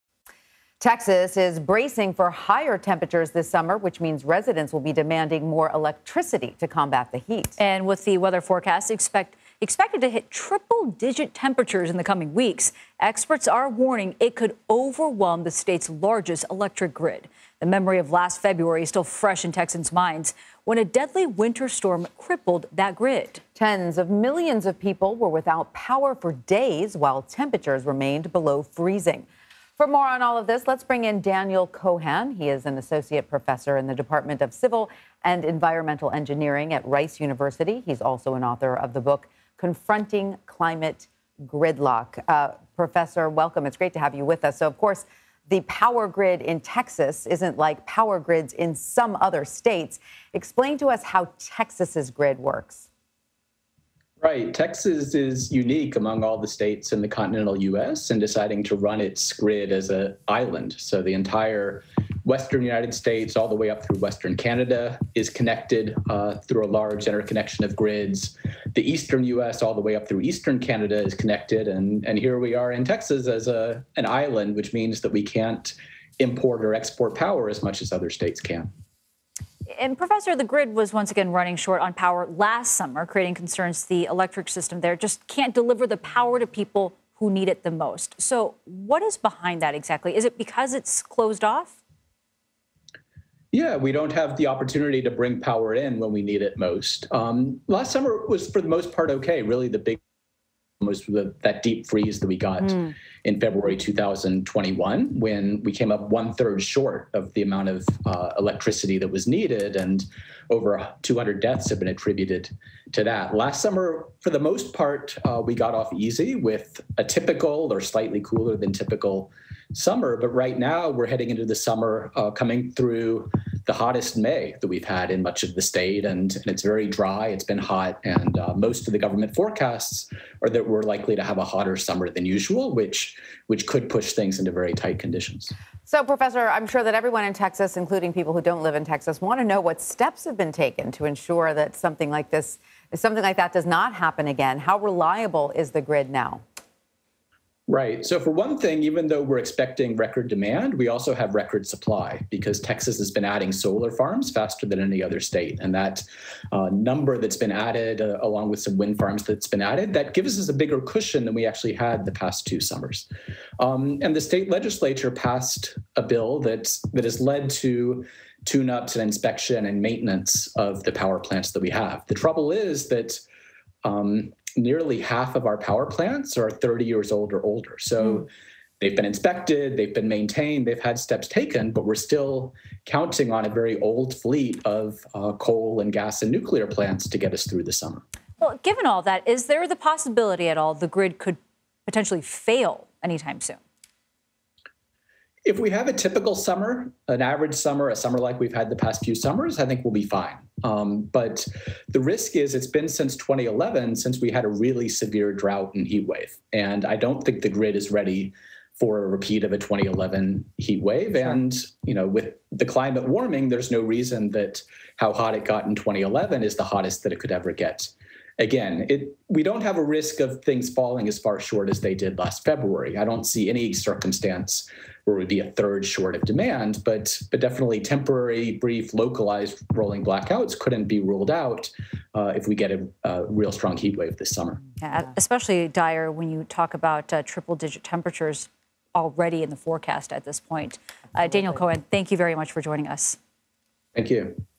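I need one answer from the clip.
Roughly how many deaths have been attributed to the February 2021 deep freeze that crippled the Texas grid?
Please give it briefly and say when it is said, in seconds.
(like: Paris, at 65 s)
over 200, at 110 s.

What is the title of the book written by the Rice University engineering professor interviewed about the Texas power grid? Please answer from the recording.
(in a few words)
Confronting Climate Gridlock.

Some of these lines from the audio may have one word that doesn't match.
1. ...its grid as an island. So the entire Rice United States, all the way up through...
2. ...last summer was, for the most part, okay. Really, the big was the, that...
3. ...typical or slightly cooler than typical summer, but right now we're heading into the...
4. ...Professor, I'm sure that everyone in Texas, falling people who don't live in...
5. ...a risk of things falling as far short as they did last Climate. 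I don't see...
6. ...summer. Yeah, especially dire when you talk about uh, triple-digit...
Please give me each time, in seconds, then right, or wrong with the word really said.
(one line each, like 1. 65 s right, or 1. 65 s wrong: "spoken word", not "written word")
1. 59 s wrong: "Western", not "Rice"
2. 97 s right
3. 117 s right
4. 136 s wrong: "including", not "falling"
5. 219 s wrong: "February", not "Climate"
6. 234 s right.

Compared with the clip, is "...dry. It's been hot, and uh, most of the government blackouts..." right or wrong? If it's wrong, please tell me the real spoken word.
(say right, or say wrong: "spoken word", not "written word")
wrong: "forecasts", not "blackouts".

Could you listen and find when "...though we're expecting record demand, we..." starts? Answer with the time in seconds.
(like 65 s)
149 s.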